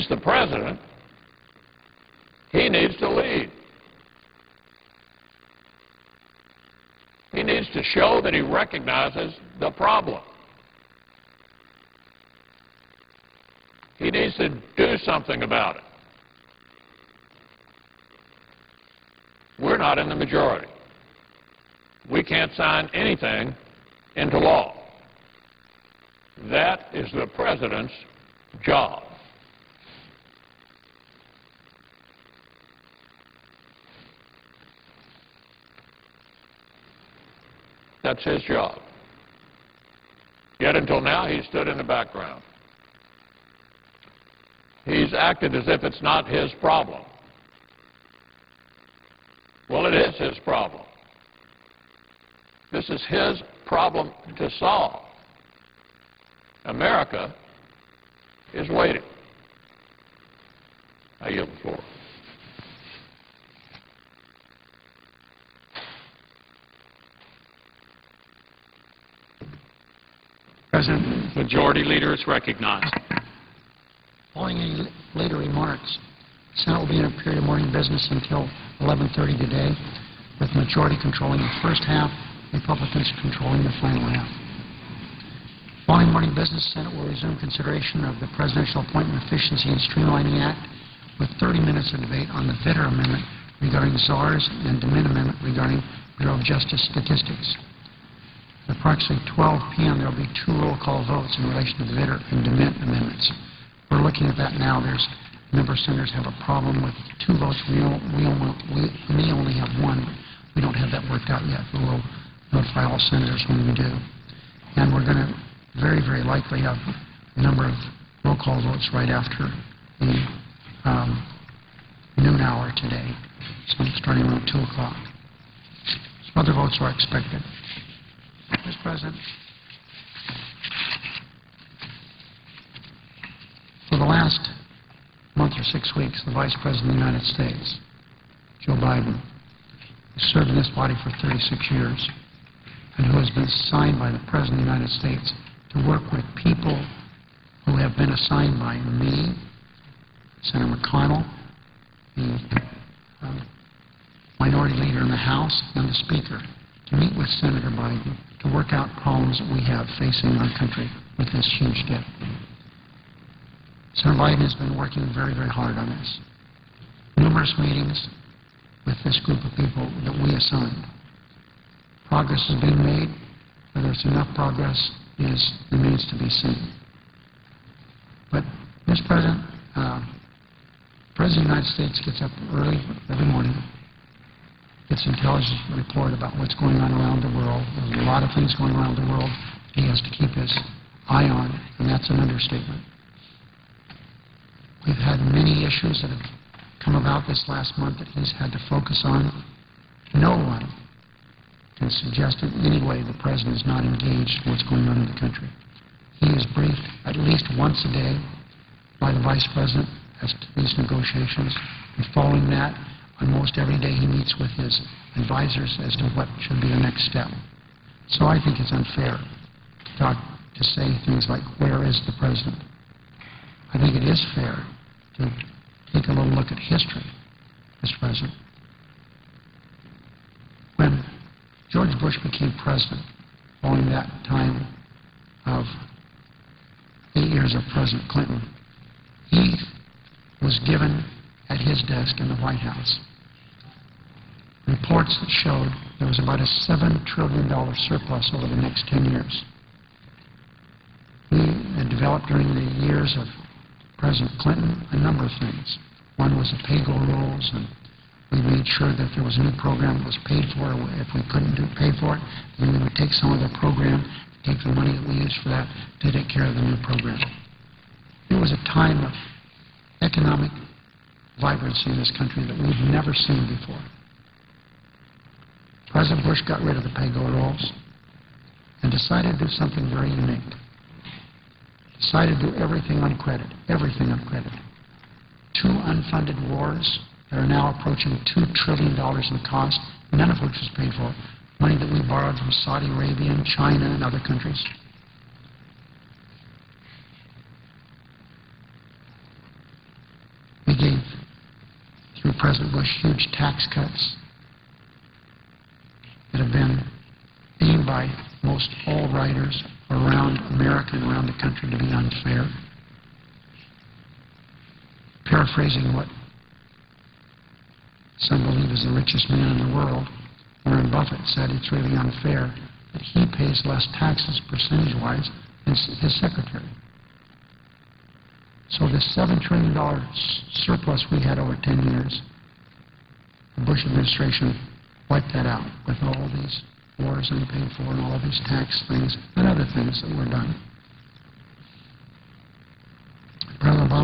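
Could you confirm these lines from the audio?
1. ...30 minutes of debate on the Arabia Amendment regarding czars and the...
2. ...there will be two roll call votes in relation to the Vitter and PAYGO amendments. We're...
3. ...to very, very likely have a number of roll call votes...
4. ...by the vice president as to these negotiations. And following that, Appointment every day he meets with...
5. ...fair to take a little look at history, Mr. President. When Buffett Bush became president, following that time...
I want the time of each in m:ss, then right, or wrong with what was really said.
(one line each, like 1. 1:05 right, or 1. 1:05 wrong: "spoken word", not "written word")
1. 1:31 wrong: "Vitter", not "Arabia"
2. 1:39 wrong: "DeMint", not "PAYGO"
3. 1:55 right
4. 3:28 wrong: "Almost", not "Appointment"
5. 3:44 wrong: "George", not "Buffett".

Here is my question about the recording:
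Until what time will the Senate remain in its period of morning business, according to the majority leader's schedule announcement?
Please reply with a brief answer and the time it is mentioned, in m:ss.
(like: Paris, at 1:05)
11:30, at 1:18.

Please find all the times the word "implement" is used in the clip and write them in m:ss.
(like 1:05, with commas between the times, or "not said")
not said.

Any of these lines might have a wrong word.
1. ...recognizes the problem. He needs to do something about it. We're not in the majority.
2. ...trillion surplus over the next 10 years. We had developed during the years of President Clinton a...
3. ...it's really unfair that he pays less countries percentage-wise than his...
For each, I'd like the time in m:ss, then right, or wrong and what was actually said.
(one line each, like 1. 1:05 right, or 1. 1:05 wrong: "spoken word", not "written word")
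1. 0:08 right
2. 4:07 right
3. 5:21 wrong: "taxes", not "countries".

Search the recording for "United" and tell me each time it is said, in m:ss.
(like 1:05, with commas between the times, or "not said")
2:17, 2:24, 3:01.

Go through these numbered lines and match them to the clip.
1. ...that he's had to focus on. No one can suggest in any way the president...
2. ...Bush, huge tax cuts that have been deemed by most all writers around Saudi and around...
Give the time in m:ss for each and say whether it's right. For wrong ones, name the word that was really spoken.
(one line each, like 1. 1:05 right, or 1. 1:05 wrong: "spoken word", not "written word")
1. 3:17 right
2. 5:02 wrong: "America", not "Saudi".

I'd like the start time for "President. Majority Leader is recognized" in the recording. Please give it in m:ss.
1:10.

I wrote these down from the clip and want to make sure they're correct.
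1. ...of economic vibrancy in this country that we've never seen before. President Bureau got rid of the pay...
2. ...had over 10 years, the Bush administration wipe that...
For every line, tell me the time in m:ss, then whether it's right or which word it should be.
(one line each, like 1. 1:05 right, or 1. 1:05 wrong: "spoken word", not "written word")
1. 4:29 wrong: "Bush", not "Bureau"
2. 5:31 right.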